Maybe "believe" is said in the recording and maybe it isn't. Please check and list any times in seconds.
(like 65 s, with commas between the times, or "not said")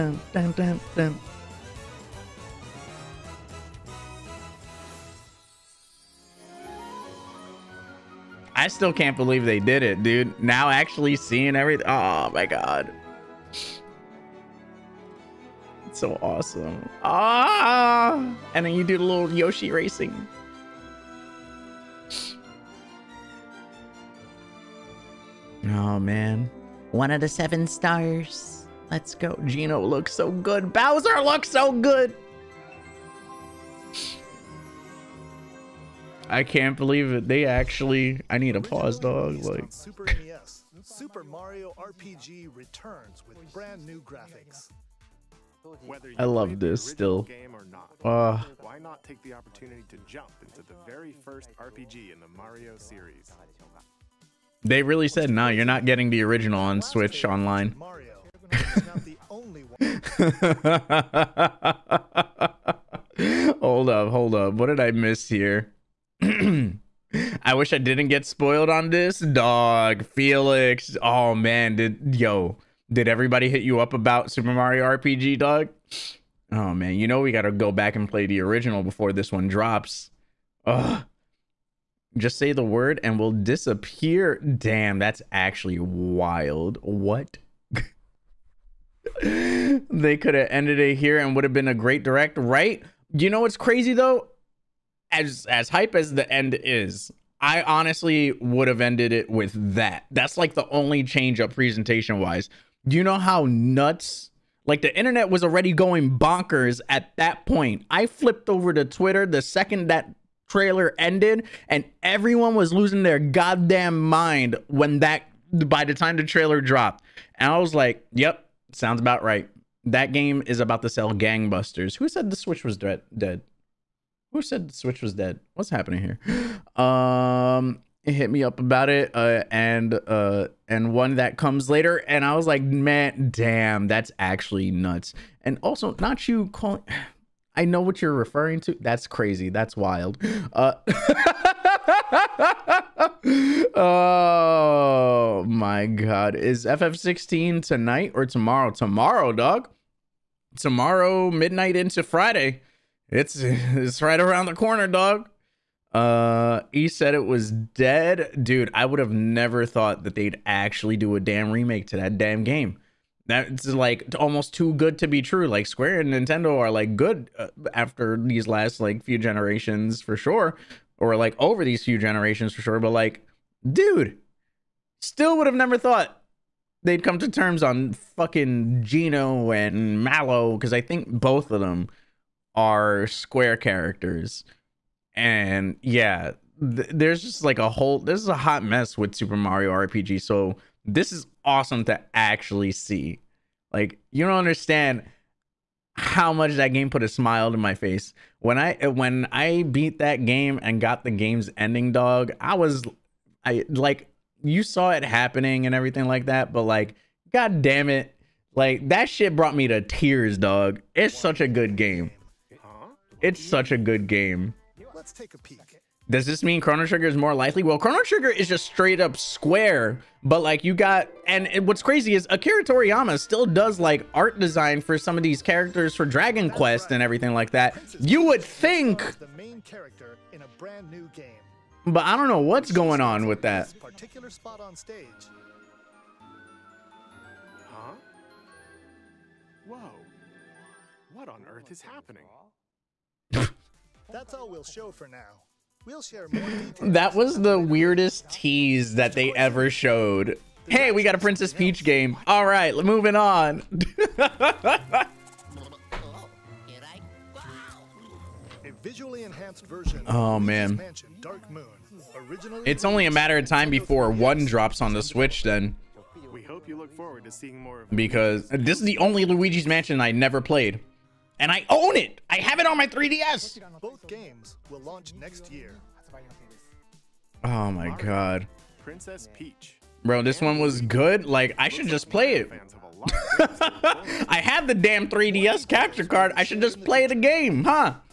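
9 s, 36 s.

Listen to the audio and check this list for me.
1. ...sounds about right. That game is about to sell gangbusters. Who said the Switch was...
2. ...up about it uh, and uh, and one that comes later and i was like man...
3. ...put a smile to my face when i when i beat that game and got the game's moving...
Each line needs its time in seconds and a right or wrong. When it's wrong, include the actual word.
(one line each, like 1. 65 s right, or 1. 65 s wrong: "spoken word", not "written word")
1. 118 s right
2. 128 s right
3. 196 s wrong: "ending", not "moving".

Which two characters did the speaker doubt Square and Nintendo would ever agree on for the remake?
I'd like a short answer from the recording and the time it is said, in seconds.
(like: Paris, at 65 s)
Geno and Mallow, at 178 s.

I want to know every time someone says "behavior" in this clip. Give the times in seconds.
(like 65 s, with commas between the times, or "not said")
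not said.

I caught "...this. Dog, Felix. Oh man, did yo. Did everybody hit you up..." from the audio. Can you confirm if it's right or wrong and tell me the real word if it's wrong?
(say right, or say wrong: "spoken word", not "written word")
right.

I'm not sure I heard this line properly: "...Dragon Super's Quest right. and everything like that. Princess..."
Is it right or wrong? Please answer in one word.
wrong.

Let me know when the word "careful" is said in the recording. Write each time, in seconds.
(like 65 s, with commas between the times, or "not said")
not said.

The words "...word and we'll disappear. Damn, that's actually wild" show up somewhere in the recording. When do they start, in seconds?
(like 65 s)
82 s.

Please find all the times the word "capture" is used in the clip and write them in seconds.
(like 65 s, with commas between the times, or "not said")
285 s.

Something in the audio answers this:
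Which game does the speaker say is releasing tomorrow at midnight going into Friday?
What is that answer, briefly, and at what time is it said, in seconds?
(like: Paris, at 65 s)
FF16, at 146 s.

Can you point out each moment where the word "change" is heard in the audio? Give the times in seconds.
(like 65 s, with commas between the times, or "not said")
101 s.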